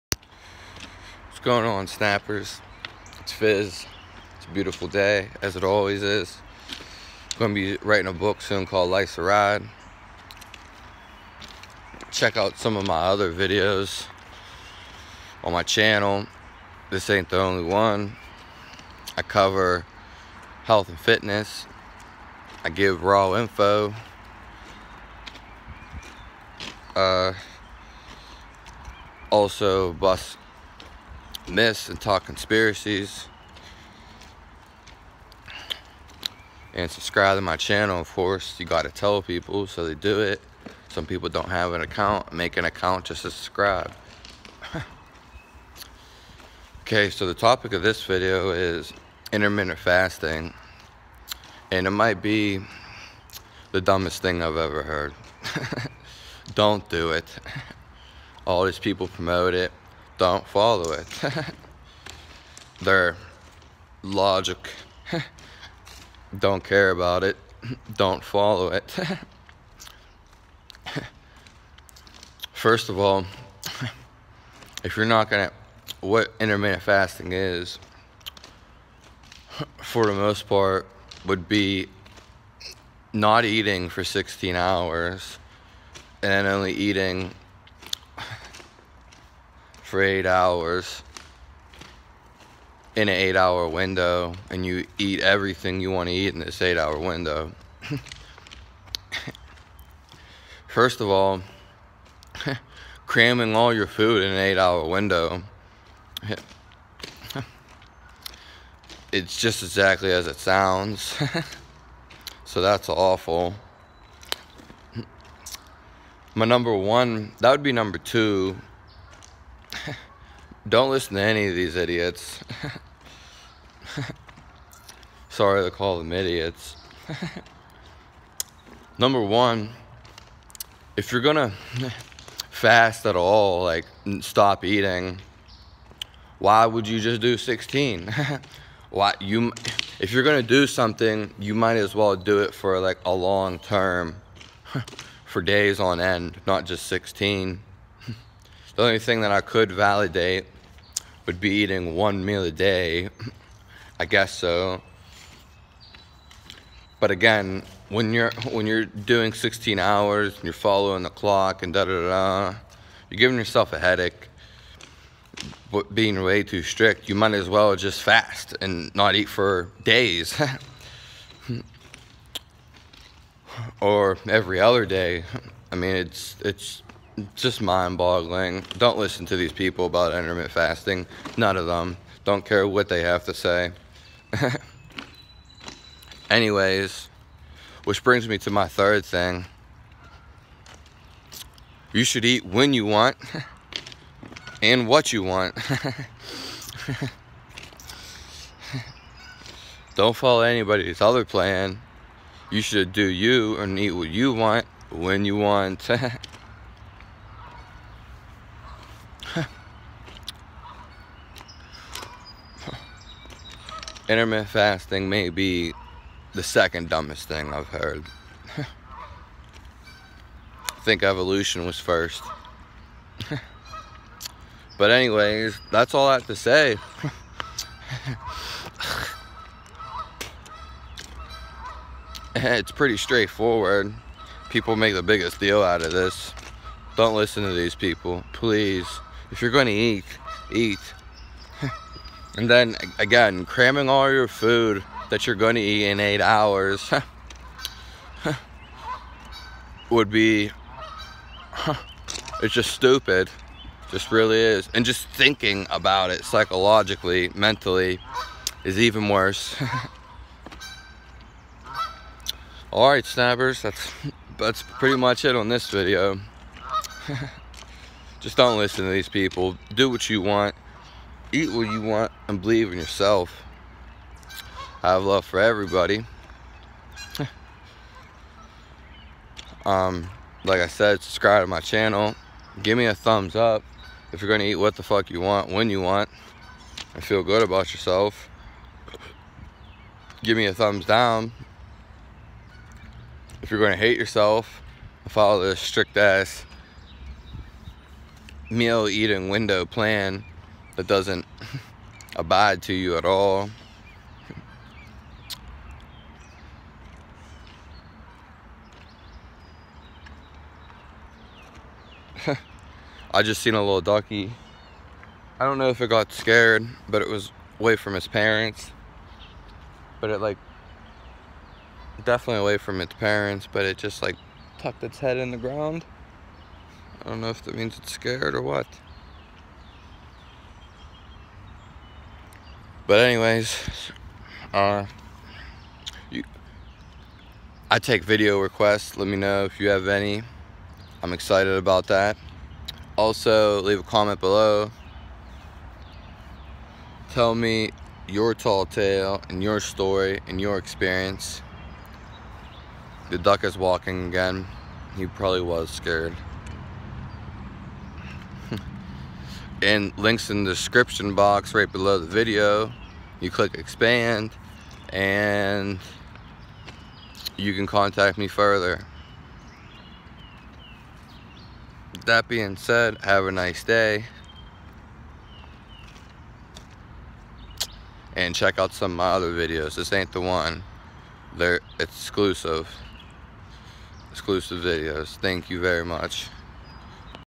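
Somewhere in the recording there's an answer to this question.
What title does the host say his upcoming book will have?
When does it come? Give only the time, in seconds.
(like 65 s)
8 s.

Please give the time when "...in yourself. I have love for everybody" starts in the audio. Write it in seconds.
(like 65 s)
272 s.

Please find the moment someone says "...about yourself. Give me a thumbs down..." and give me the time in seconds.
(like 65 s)
287 s.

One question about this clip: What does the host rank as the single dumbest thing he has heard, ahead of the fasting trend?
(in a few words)
Evolution.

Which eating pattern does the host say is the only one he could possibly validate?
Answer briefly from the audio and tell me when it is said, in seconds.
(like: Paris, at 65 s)
One meal a day, at 151 s.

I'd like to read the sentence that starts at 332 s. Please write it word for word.
But anyways, uh, you, I take video requests.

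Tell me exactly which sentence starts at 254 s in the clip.
And just thinking about it psychologically, mentally, is even worse.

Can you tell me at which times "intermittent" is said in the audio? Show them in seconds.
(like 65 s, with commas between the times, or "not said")
49 s, 76 s, 180 s, 214 s.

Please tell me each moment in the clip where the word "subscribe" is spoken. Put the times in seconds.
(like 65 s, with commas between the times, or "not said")
36 s, 43 s, 281 s.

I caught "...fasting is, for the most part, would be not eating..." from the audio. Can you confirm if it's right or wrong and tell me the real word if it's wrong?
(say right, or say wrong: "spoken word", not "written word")
right.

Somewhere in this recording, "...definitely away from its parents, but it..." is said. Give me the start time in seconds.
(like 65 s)
322 s.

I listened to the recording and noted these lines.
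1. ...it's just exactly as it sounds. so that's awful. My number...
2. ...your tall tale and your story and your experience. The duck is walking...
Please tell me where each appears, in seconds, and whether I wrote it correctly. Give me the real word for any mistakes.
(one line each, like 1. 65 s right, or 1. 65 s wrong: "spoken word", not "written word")
1. 109 s right
2. 348 s right.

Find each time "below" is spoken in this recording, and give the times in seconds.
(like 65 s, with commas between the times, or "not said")
344 s, 361 s.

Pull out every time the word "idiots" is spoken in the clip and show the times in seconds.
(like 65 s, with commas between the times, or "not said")
121 s, 126 s.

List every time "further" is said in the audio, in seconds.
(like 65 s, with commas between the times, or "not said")
368 s.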